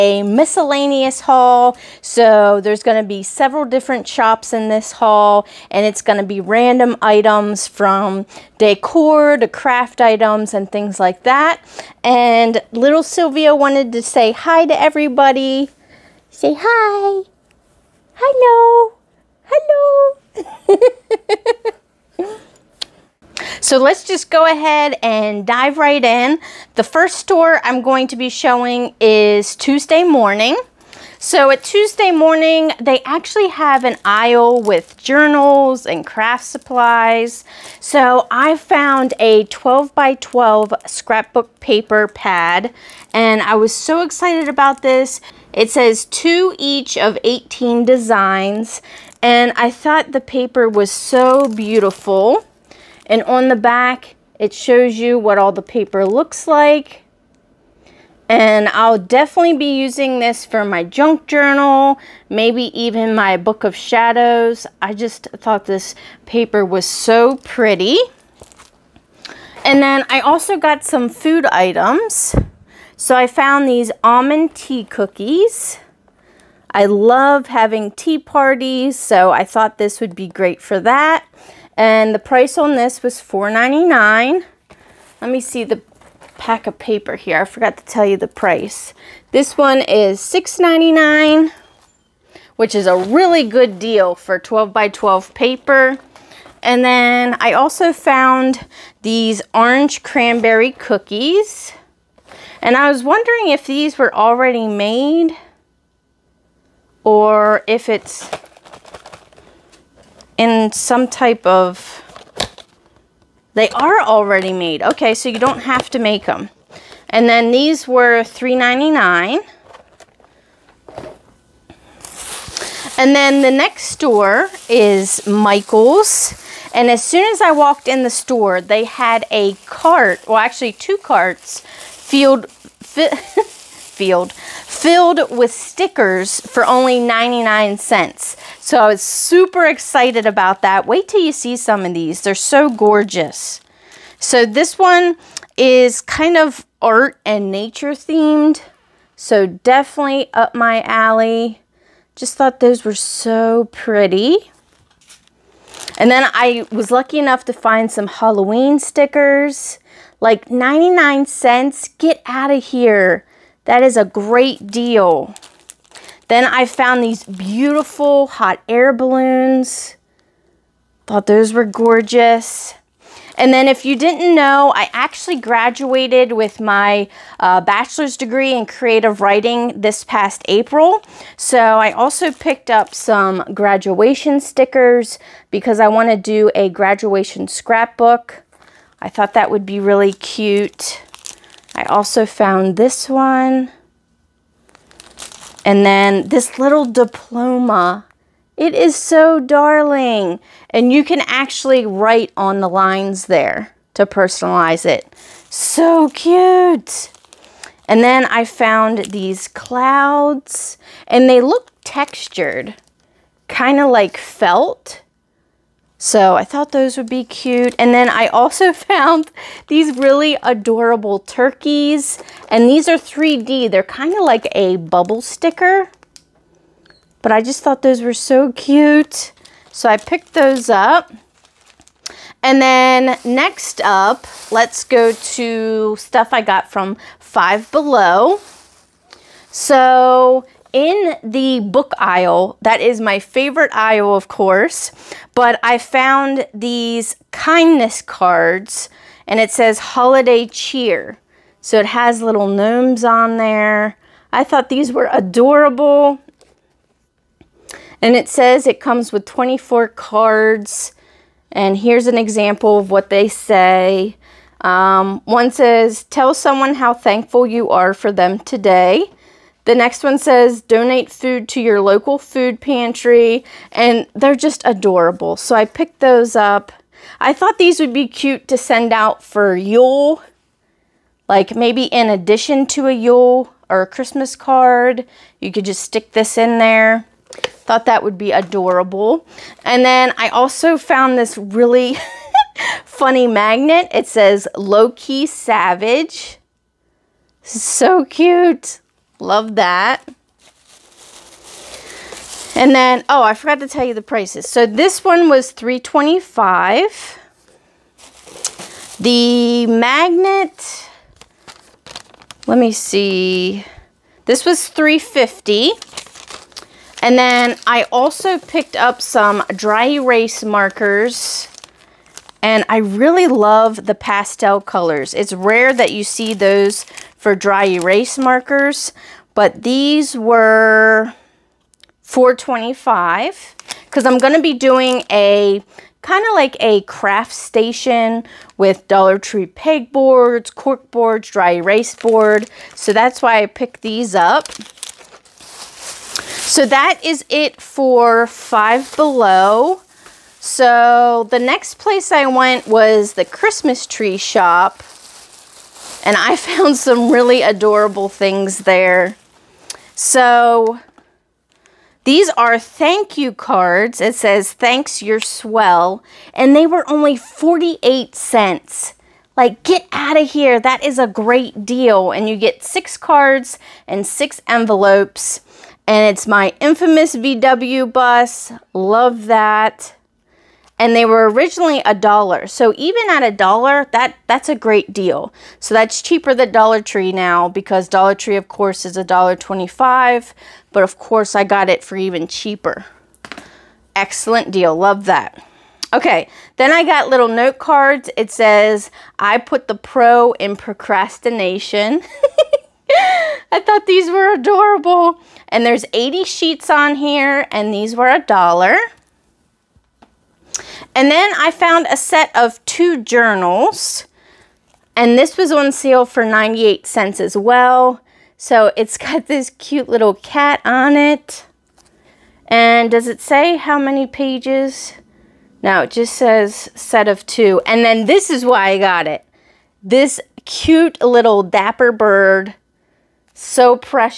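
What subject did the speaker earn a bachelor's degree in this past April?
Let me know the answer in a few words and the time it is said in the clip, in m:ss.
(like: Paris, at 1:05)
Creative writing, at 2:58.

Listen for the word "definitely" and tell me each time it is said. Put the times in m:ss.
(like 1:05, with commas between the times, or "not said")
0:58, 2:29.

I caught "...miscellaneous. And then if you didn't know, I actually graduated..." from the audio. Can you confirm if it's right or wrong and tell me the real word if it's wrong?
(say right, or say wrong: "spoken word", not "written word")
wrong: "gorgeous", not "miscellaneous".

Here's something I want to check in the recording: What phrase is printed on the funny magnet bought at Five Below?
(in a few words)
Low-key savage.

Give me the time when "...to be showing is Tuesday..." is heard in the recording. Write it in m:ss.
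0:28.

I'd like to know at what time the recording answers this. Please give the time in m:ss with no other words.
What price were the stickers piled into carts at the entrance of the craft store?
2:16.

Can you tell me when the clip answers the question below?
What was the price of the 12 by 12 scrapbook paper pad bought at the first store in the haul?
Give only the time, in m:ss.
1:29.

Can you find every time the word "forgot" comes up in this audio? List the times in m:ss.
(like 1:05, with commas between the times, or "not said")
1:27, 5:03.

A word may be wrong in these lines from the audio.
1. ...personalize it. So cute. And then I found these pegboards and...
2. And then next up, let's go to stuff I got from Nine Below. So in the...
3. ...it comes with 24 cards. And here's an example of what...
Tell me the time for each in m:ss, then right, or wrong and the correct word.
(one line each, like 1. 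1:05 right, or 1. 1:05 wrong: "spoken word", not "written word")
1. 3:24 wrong: "clouds", not "pegboards"
2. 3:52 wrong: "Five", not "Nine"
3. 4:18 right.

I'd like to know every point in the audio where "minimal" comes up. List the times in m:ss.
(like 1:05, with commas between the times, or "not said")
not said.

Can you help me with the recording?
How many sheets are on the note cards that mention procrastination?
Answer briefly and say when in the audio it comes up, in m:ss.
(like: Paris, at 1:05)
80, at 6:45.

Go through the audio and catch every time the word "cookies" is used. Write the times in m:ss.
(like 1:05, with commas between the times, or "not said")
1:14, 1:40.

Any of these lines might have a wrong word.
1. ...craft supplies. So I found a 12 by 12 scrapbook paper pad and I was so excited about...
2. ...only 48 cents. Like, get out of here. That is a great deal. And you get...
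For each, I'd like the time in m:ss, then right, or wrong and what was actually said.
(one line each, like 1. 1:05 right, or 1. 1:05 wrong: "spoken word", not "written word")
1. 0:36 right
2. 6:06 right.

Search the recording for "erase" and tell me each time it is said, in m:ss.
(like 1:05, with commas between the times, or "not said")
5:19, 5:27, 5:41.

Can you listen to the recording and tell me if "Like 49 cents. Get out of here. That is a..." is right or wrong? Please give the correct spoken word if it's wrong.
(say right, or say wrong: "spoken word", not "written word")
wrong: "99", not "49".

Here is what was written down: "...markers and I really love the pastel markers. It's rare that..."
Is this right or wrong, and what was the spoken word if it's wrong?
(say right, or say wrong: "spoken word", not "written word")
wrong: "colors", not "markers".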